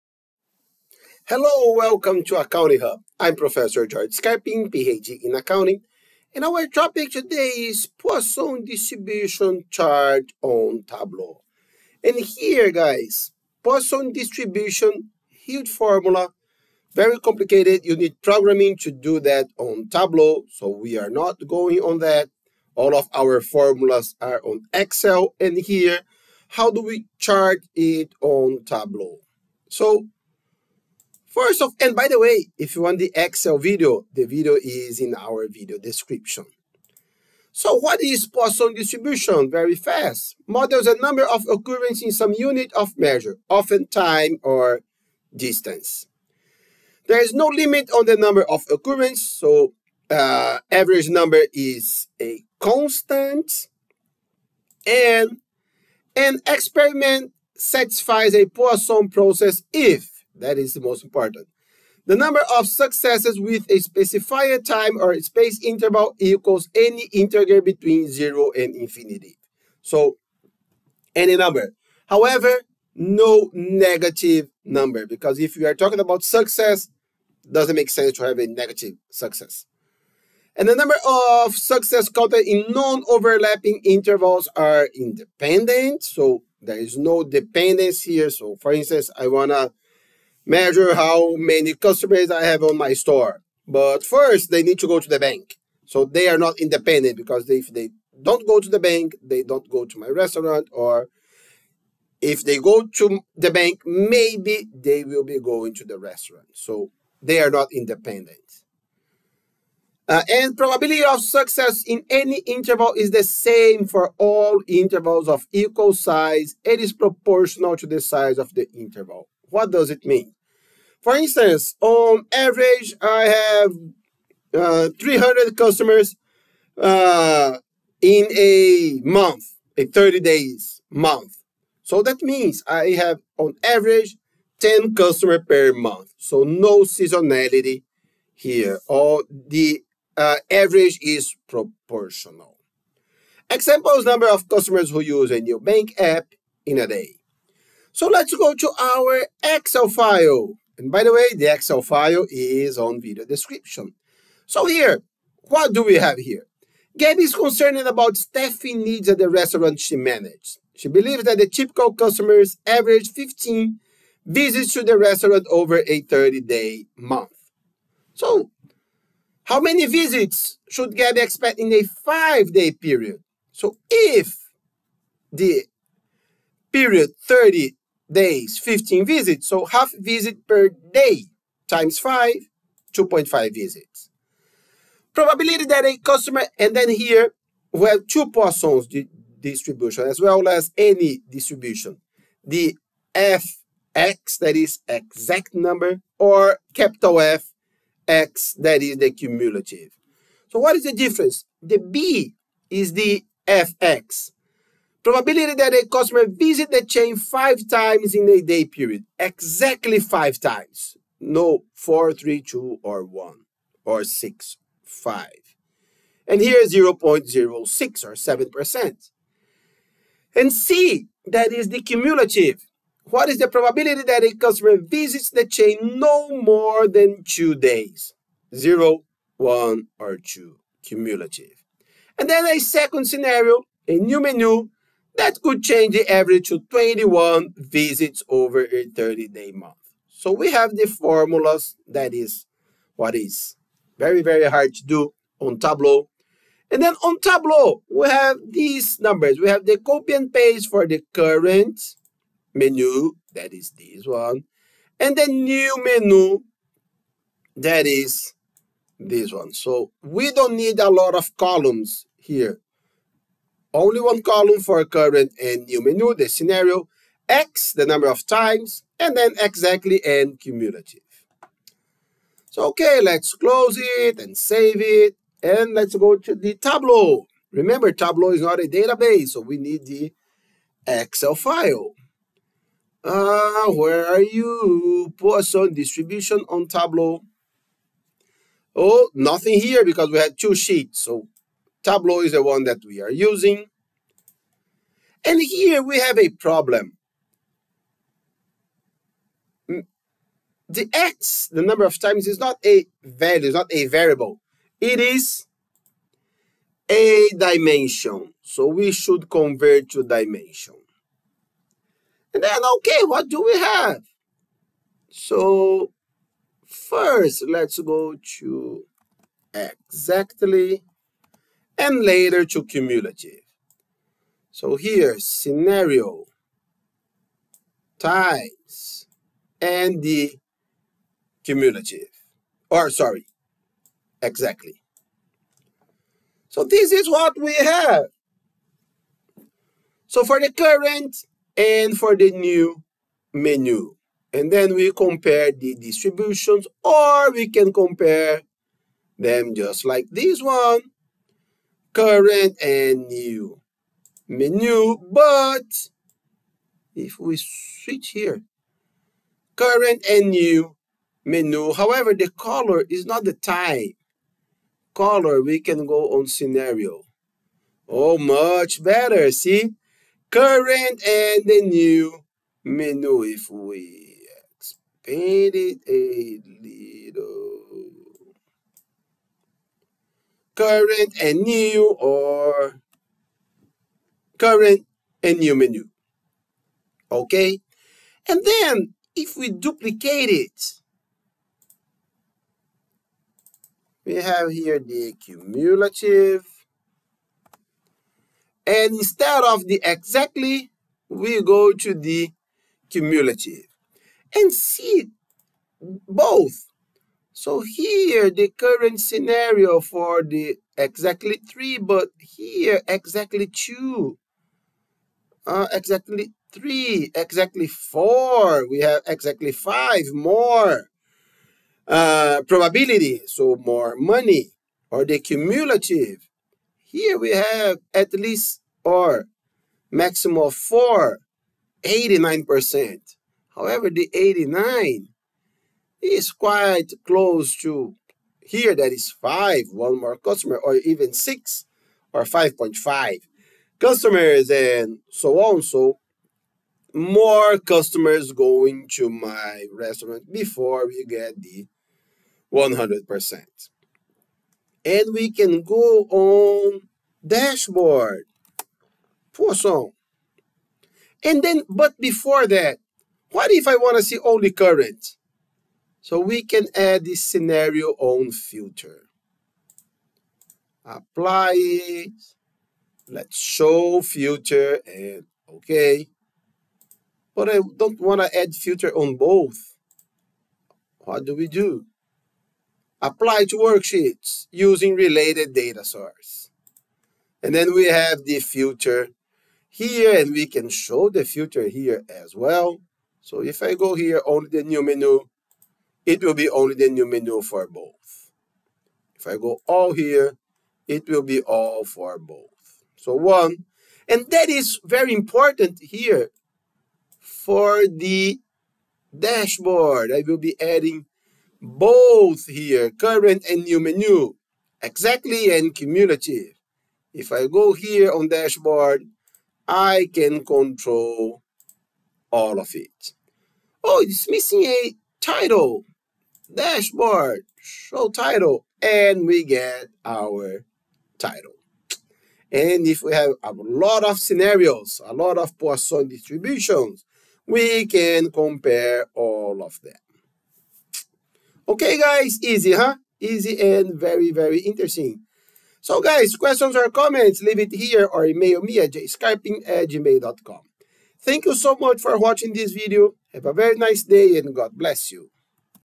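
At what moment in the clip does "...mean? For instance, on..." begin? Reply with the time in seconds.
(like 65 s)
120 s.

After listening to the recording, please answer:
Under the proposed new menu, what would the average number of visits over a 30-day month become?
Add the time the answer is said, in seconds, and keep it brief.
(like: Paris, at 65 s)
21, at 236 s.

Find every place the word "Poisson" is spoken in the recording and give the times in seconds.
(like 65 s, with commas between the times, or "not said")
7 s, 13 s, 38 s, 58 s, 188 s, 285 s, 459 s, 535 s.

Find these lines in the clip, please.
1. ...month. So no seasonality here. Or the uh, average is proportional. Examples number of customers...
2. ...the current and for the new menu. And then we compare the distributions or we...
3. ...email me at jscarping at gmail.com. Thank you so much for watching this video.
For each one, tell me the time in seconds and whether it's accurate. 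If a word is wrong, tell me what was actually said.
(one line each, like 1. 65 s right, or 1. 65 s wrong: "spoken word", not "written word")
1. 135 s right
2. 340 s right
3. 548 s right.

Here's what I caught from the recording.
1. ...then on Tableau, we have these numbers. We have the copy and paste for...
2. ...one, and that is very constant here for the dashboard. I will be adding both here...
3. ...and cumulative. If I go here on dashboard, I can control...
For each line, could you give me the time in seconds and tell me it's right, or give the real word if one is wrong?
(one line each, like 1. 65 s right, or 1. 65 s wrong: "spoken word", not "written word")
1. 246 s right
2. 503 s wrong: "important", not "constant"
3. 515 s right.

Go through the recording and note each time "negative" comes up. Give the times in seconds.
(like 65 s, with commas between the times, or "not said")
73 s, 78 s.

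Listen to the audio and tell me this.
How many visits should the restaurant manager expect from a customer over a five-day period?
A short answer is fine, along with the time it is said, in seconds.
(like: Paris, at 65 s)
2.5, at 182 s.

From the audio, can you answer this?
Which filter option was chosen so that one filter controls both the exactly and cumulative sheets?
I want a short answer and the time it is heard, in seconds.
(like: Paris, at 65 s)
Apply to worksheets using related data source, at 482 s.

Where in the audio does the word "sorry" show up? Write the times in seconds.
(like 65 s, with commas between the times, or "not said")
332 s.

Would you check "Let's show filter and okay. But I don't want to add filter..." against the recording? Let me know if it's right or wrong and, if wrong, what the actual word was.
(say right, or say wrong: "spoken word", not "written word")
right.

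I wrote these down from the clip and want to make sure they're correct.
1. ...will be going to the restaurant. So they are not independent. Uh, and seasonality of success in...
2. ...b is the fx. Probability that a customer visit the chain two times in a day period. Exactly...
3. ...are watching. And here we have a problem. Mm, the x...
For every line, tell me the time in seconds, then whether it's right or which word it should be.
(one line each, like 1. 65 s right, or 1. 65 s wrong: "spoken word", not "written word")
1. 105 s wrong: "probability", not "seasonality"
2. 201 s wrong: "five", not "two"
3. 293 s wrong: "using", not "watching".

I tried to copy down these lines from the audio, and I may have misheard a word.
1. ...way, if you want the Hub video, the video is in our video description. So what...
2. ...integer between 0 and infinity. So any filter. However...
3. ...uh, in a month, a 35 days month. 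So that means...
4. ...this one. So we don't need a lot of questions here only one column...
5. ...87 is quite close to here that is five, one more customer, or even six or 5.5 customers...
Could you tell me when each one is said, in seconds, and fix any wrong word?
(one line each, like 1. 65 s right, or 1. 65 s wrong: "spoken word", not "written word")
1. 32 s wrong: "Excel", not "Hub"
2. 67 s wrong: "number", not "filter"
3. 126 s wrong: "30", not "35"
4. 258 s wrong: "columns", not "questions"
5. 434 s wrong: "89", not "87".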